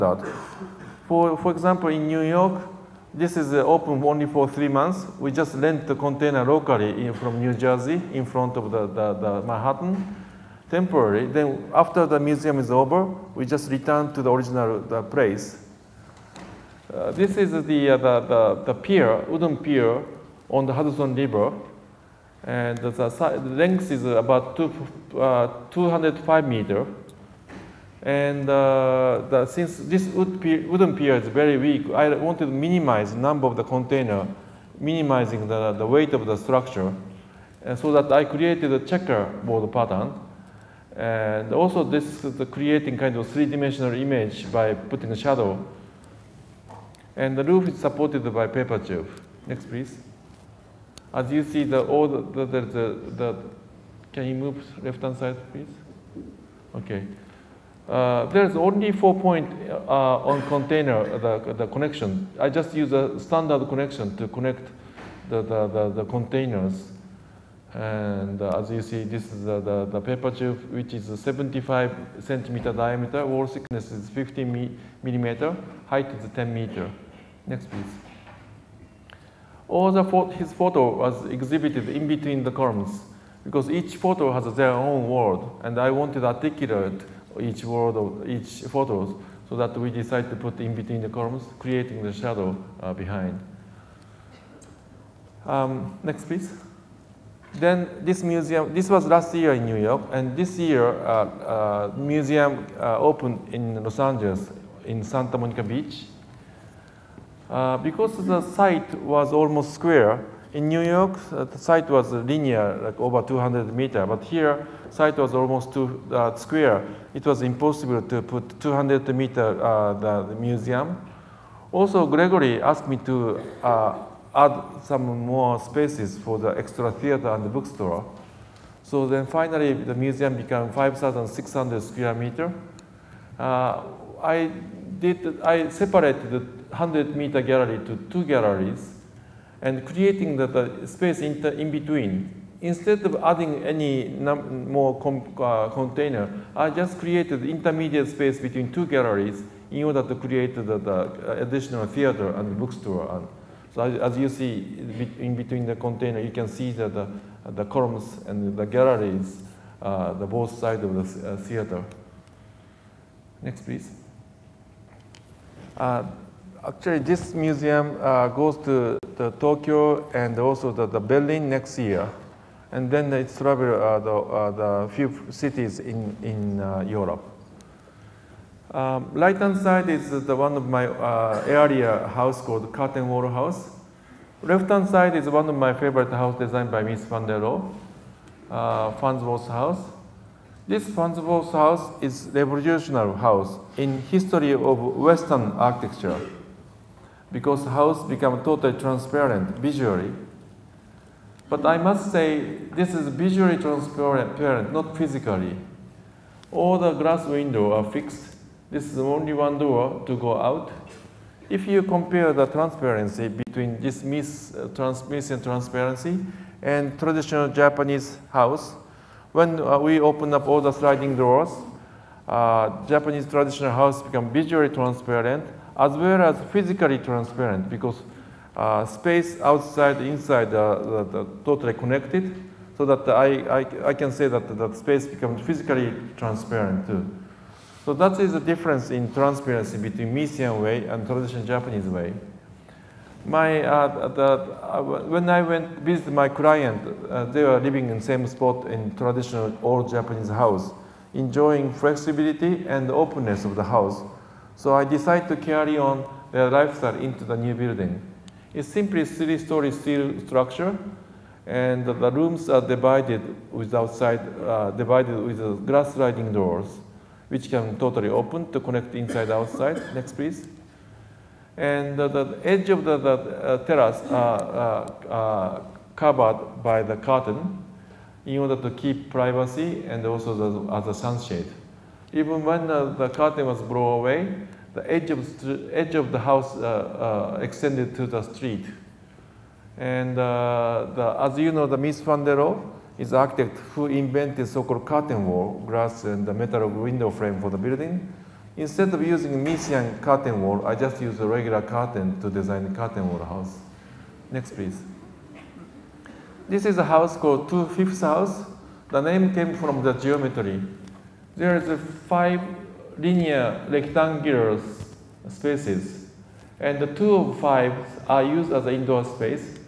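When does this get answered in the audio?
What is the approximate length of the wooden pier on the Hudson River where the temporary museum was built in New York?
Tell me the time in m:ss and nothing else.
0:25.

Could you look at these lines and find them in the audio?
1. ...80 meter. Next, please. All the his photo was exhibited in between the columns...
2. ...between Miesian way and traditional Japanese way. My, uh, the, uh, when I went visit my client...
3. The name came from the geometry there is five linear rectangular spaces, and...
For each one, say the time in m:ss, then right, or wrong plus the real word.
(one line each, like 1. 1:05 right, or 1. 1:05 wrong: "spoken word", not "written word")
1. 1:16 wrong: "10", not "80"
2. 3:59 right
3. 5:08 right.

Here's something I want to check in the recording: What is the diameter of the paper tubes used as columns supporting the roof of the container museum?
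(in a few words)
75 centimeters.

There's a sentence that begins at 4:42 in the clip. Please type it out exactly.
Even when uh, the curtain was blown away, the edge of, the, edge of the house uh, uh, extended to the street.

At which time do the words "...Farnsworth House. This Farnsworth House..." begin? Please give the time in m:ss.
3:08.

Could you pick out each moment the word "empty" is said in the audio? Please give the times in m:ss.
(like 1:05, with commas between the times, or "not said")
not said.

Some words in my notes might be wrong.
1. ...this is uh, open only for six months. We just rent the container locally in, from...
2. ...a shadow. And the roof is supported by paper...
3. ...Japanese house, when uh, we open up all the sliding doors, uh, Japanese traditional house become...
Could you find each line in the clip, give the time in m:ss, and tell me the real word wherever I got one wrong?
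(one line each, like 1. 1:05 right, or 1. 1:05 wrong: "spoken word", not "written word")
1. 0:03 wrong: "three", not "six"
2. 0:45 right
3. 3:37 right.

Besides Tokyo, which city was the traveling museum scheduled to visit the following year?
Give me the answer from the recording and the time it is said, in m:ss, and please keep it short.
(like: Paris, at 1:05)
Berlin, at 2:50.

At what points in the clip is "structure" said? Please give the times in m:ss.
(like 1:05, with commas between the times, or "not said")
0:36, 4:20.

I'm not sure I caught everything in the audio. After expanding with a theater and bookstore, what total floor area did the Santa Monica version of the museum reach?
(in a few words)
5,600 square meters.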